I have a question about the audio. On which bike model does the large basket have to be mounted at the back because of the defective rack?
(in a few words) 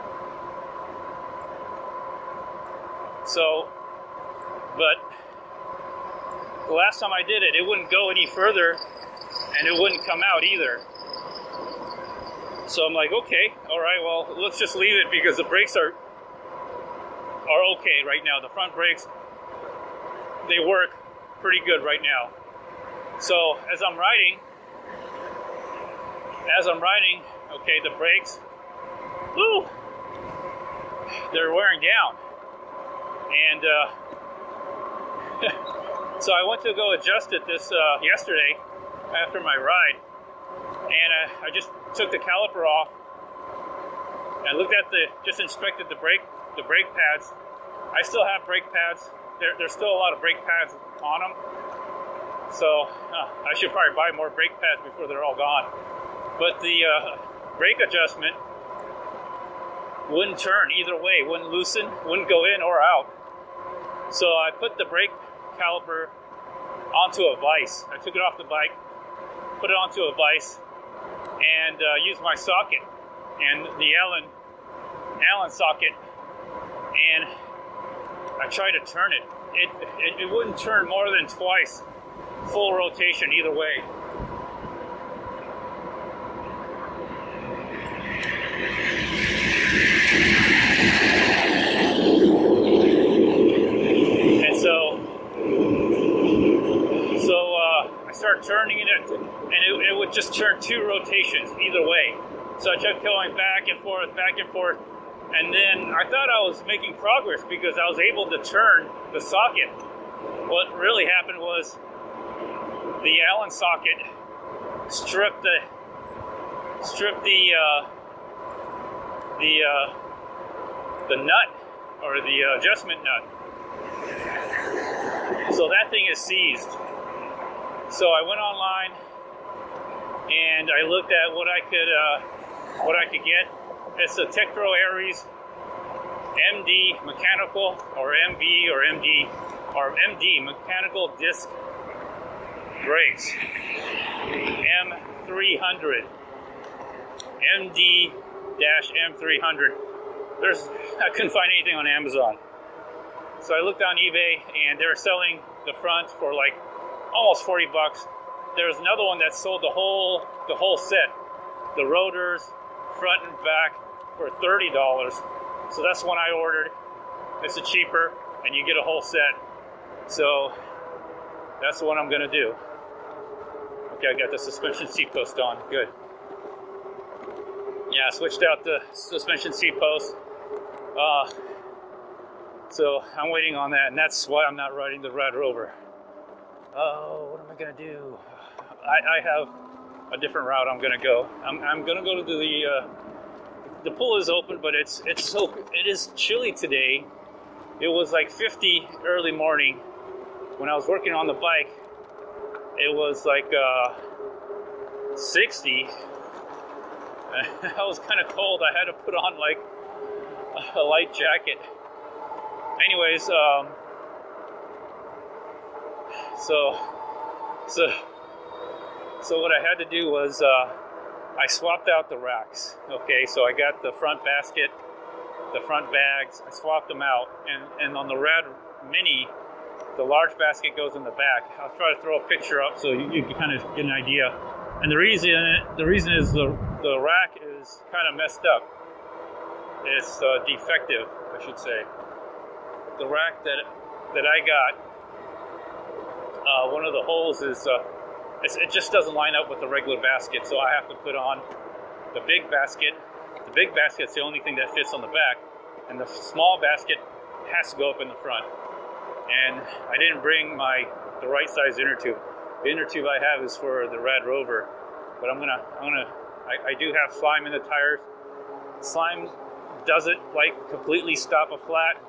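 Rad Mini.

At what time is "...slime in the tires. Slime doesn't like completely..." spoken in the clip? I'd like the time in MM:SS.
04:27.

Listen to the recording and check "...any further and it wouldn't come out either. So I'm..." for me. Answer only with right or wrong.
right.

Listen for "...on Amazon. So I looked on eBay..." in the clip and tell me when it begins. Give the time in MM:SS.
02:31.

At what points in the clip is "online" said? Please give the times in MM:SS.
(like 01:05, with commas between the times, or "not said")
02:08.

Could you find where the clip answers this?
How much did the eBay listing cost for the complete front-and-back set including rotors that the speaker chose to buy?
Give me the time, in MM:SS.
02:44.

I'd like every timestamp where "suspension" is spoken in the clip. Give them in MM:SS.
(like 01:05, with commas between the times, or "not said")
02:54, 02:58.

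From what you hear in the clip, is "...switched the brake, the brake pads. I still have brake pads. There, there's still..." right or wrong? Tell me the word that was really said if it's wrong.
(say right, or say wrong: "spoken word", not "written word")
wrong: "inspected", not "switched".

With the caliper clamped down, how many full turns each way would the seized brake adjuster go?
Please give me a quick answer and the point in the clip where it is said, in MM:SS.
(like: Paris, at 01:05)
2, at 01:21.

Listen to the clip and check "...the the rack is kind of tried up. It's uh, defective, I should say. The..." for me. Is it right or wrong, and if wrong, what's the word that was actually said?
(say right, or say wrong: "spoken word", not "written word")
wrong: "messed", not "tried".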